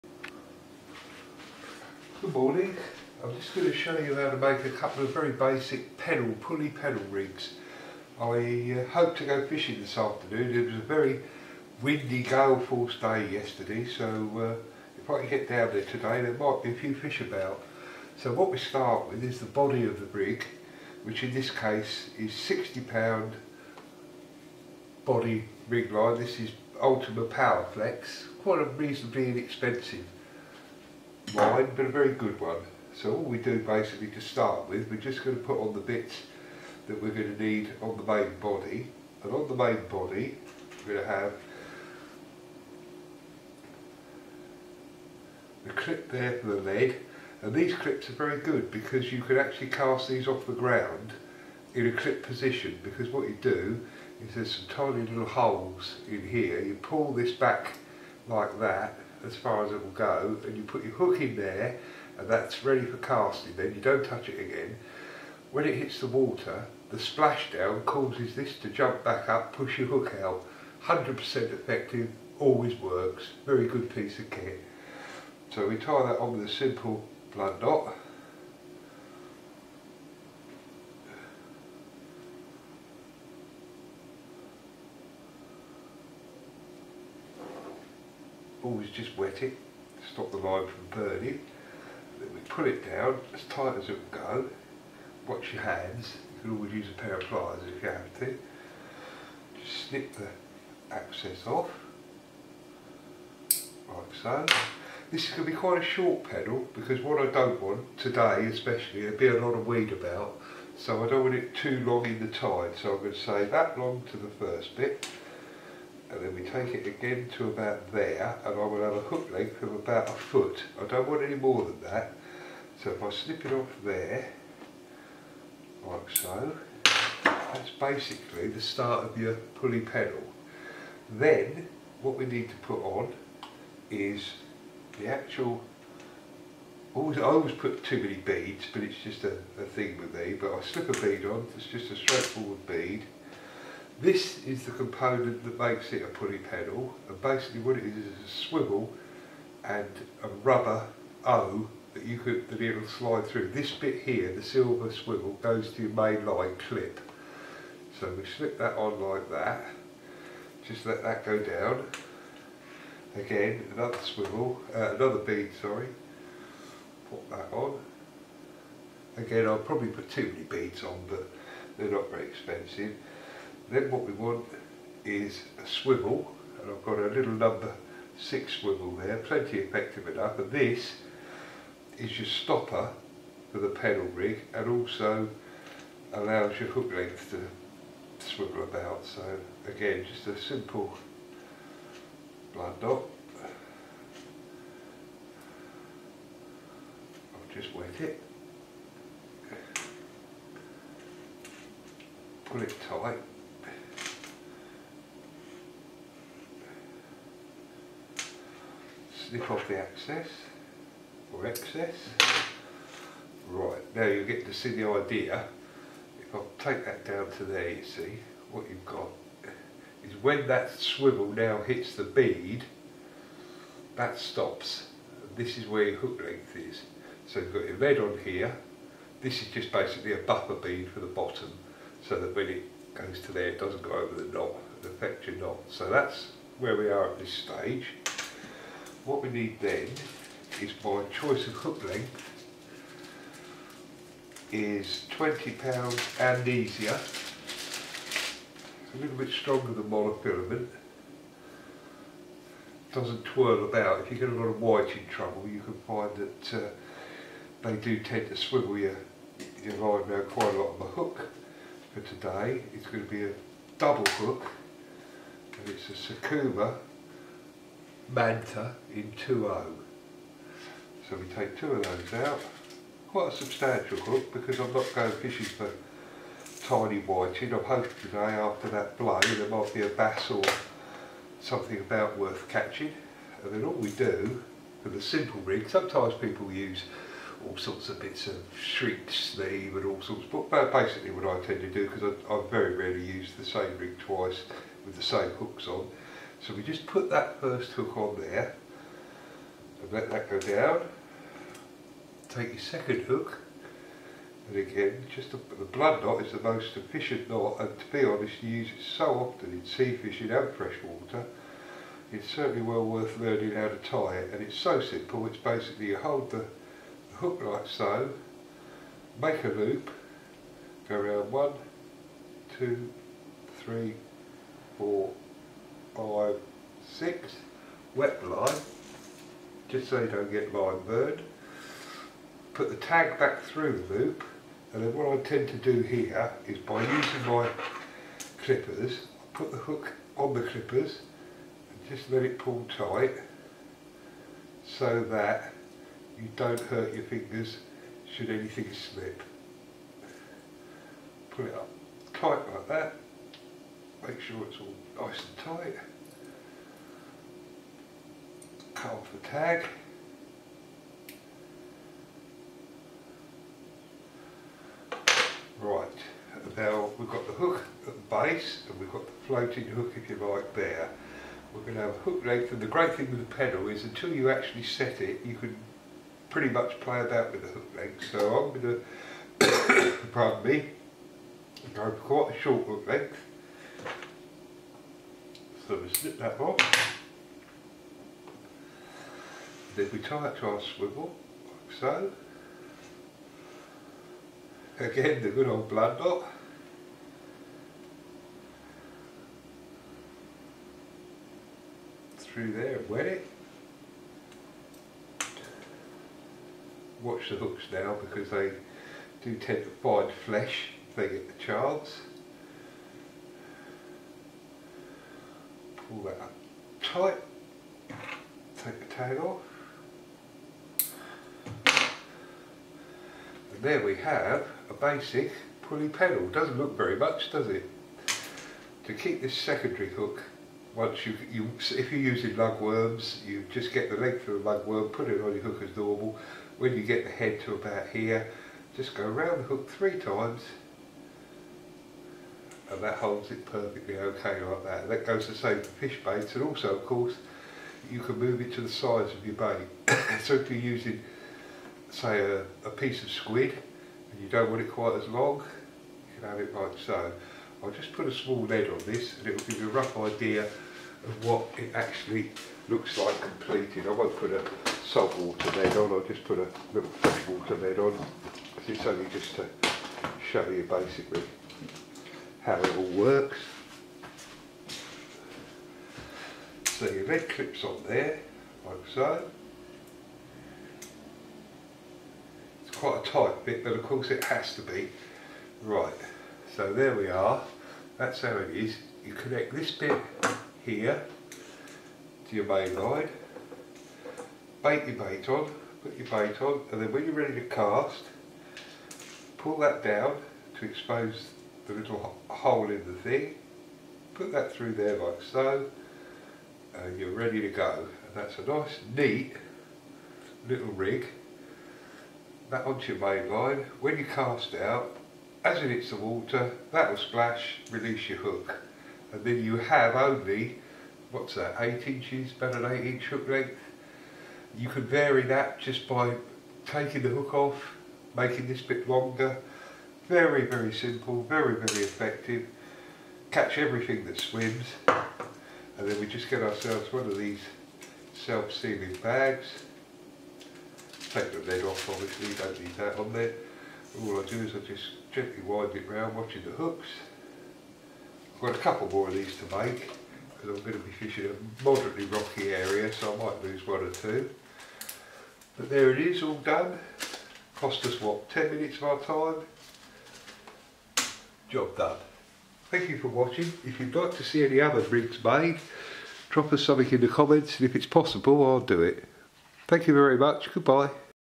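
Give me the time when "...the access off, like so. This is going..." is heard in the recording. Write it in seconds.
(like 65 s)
100 s.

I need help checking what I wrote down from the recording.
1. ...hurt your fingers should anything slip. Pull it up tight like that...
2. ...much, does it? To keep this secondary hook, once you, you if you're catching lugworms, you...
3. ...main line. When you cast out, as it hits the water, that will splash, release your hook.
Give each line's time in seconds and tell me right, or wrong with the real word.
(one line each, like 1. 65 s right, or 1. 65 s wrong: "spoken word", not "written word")
1. 346 s right
2. 426 s wrong: "using", not "catching"
3. 513 s right.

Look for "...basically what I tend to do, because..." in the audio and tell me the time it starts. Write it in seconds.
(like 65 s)
290 s.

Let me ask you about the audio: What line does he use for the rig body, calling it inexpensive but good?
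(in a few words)
Ultima Power Flex.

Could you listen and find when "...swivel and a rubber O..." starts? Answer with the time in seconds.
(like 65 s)
148 s.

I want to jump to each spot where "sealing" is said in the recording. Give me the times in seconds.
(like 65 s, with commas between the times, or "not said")
538 s.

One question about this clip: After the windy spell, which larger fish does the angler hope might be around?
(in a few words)
bass.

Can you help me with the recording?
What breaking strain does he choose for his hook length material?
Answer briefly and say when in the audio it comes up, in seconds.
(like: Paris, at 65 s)
20 pound, at 245 s.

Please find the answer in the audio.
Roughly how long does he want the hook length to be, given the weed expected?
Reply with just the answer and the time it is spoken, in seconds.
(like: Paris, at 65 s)
about a foot, at 119 s.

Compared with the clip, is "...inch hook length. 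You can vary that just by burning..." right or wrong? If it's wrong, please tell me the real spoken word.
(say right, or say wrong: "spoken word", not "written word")
wrong: "taking", not "burning".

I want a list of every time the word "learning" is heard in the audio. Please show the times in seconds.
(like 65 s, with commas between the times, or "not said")
313 s.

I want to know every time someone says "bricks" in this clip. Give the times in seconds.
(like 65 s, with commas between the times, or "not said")
564 s.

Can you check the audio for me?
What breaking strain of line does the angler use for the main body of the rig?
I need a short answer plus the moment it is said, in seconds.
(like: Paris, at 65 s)
60 pound, at 22 s.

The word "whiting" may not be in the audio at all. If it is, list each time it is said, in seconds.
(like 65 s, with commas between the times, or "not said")
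254 s, 277 s.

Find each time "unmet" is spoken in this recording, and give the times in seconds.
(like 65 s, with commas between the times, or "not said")
not said.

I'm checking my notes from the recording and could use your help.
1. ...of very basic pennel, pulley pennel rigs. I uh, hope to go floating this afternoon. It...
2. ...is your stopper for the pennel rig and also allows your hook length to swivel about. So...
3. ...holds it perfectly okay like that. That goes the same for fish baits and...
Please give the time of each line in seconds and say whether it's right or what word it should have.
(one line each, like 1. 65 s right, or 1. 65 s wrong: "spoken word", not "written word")
1. 5 s wrong: "fishing", not "floating"
2. 181 s right
3. 442 s right.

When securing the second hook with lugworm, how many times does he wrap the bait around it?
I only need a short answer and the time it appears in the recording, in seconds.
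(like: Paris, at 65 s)
3, at 439 s.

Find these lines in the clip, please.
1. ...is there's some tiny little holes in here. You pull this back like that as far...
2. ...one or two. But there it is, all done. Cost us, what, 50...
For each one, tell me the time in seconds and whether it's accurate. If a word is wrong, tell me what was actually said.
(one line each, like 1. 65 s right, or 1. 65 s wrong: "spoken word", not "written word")
1. 54 s right
2. 553 s wrong: "10", not "50".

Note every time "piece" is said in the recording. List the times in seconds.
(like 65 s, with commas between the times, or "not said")
73 s, 452 s.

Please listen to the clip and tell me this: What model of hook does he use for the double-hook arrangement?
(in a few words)
Sakuma Manta.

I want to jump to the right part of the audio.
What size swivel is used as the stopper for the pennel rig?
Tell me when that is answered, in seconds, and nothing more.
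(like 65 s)
177 s.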